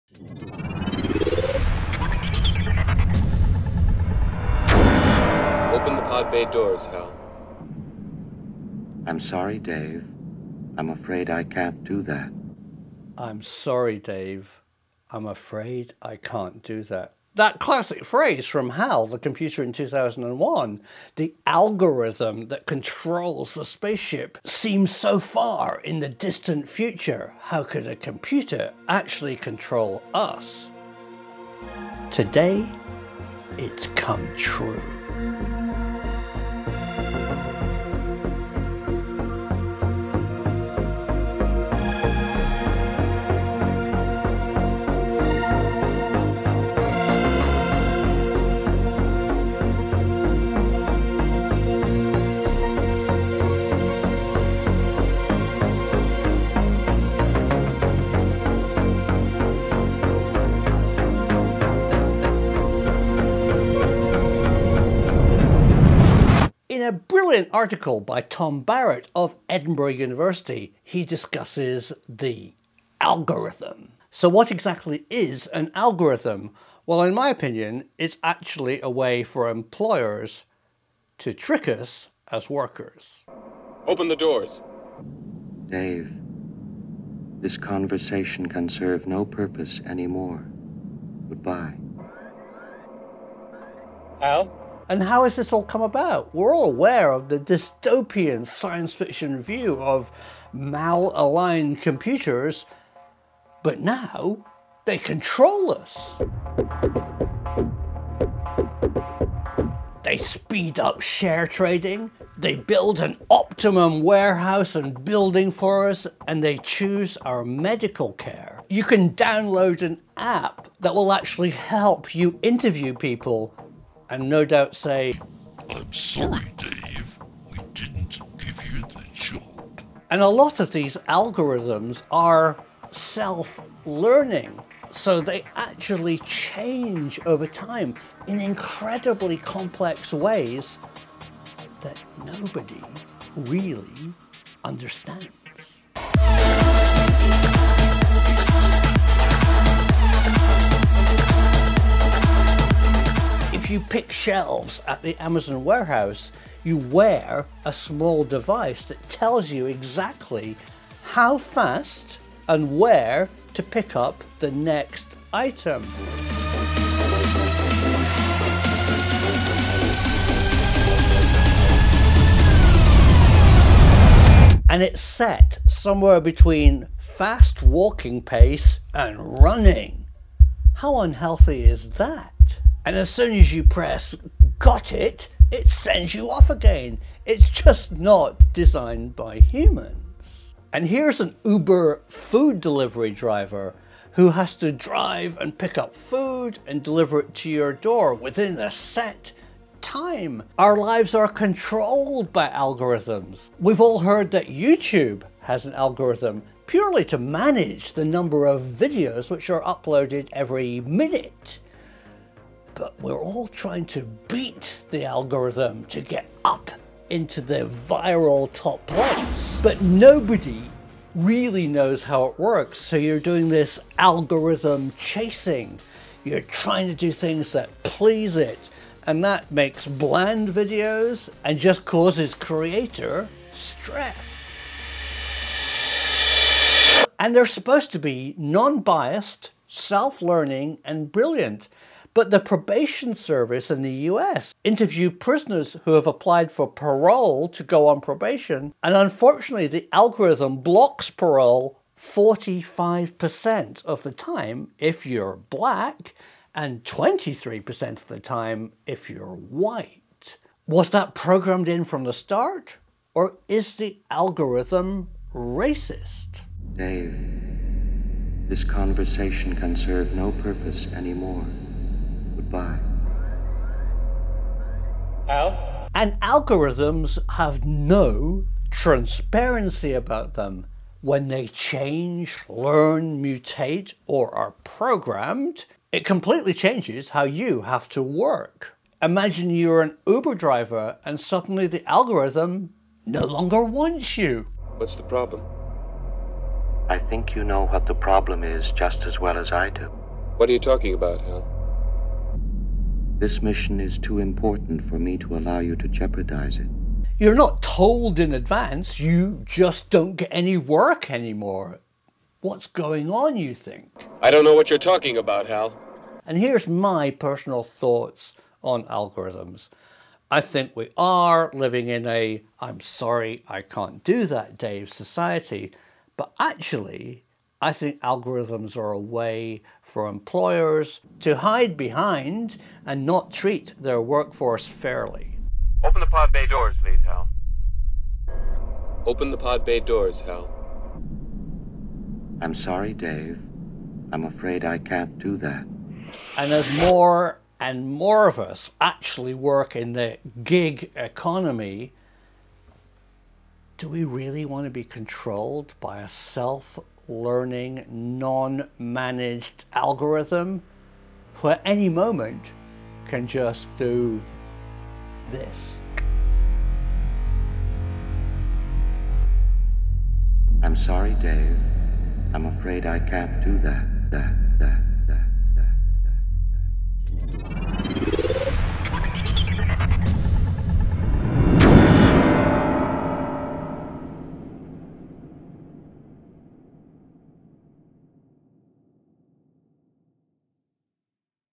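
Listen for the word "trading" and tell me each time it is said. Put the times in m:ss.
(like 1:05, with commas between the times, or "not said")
1:51.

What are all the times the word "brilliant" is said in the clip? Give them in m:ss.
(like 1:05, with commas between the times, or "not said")
1:06, 4:01.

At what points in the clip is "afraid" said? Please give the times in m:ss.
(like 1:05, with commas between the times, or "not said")
0:10, 0:15, 5:44, 6:12.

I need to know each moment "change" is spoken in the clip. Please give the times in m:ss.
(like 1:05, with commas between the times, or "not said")
2:16, 4:41, 4:46.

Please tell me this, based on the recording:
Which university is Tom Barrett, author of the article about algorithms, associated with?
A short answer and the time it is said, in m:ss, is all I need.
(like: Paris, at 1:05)
Edinburgh University, at 1:09.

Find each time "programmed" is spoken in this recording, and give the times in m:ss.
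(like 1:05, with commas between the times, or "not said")
4:21, 4:44.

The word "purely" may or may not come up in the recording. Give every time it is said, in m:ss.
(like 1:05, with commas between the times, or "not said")
3:26.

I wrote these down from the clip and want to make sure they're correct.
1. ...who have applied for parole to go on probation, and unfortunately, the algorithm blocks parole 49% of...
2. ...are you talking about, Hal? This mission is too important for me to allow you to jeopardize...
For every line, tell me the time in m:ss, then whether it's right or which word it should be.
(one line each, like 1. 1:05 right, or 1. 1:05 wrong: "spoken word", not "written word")
1. 4:05 wrong: "45", not "49"
2. 5:00 right.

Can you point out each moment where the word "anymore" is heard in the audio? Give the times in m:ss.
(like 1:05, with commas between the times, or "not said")
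1:29, 4:30, 5:11.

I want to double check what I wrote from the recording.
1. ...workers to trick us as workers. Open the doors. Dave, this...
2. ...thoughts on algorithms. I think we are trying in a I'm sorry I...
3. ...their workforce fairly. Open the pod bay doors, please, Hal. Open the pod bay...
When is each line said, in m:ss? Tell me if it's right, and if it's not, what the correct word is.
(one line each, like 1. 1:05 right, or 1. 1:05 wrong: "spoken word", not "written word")
1. 1:19 wrong: "employers", not "workers"
2. 5:17 wrong: "living", not "trying"
3. 5:33 right.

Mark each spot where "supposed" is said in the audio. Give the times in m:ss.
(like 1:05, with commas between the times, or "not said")
3:57.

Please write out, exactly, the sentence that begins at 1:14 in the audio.
So what exactly is an algorithm?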